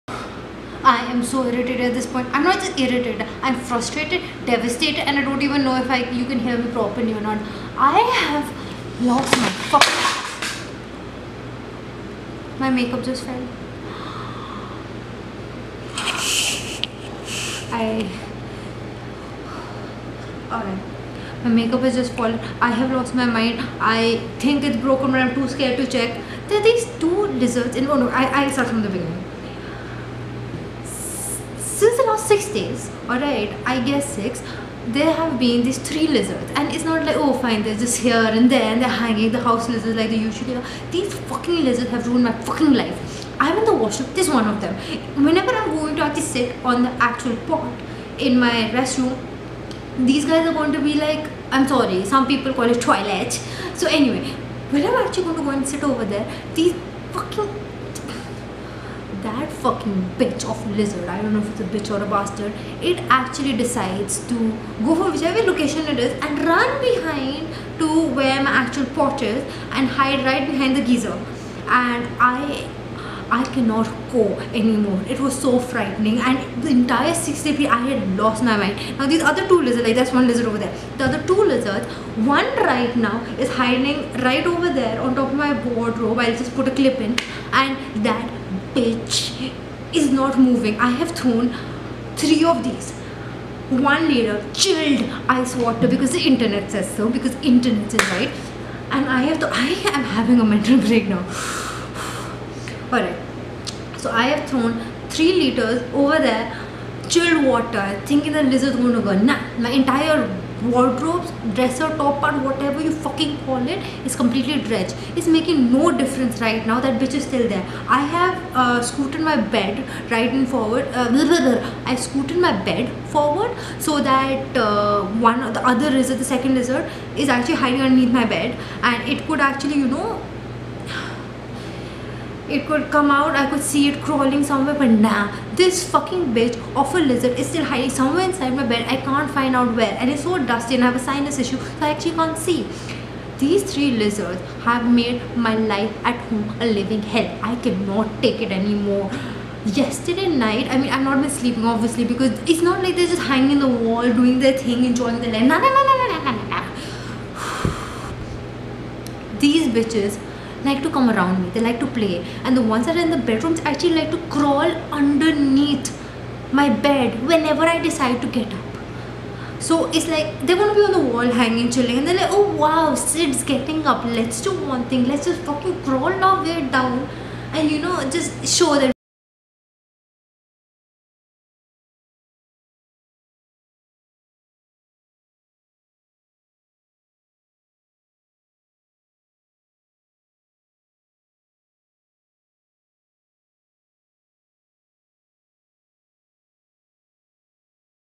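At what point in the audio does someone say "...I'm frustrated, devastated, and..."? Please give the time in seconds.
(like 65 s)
3 s.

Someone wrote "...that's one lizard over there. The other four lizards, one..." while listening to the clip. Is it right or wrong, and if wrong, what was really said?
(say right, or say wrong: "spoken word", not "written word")
wrong: "two", not "four".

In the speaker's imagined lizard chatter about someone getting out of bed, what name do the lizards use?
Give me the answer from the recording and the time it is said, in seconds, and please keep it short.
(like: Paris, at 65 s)
Sid, at 172 s.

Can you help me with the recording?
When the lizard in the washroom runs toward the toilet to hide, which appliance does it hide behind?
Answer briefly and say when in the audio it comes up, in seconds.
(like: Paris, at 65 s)
geyser, at 70 s.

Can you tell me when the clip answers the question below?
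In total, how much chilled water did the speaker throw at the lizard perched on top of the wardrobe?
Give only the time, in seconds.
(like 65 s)
105 s.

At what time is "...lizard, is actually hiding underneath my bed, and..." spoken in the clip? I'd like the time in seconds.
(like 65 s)
126 s.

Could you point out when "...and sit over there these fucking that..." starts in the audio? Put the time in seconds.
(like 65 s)
55 s.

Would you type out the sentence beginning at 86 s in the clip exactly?
I'll just put a clip in and that bitch is not moving.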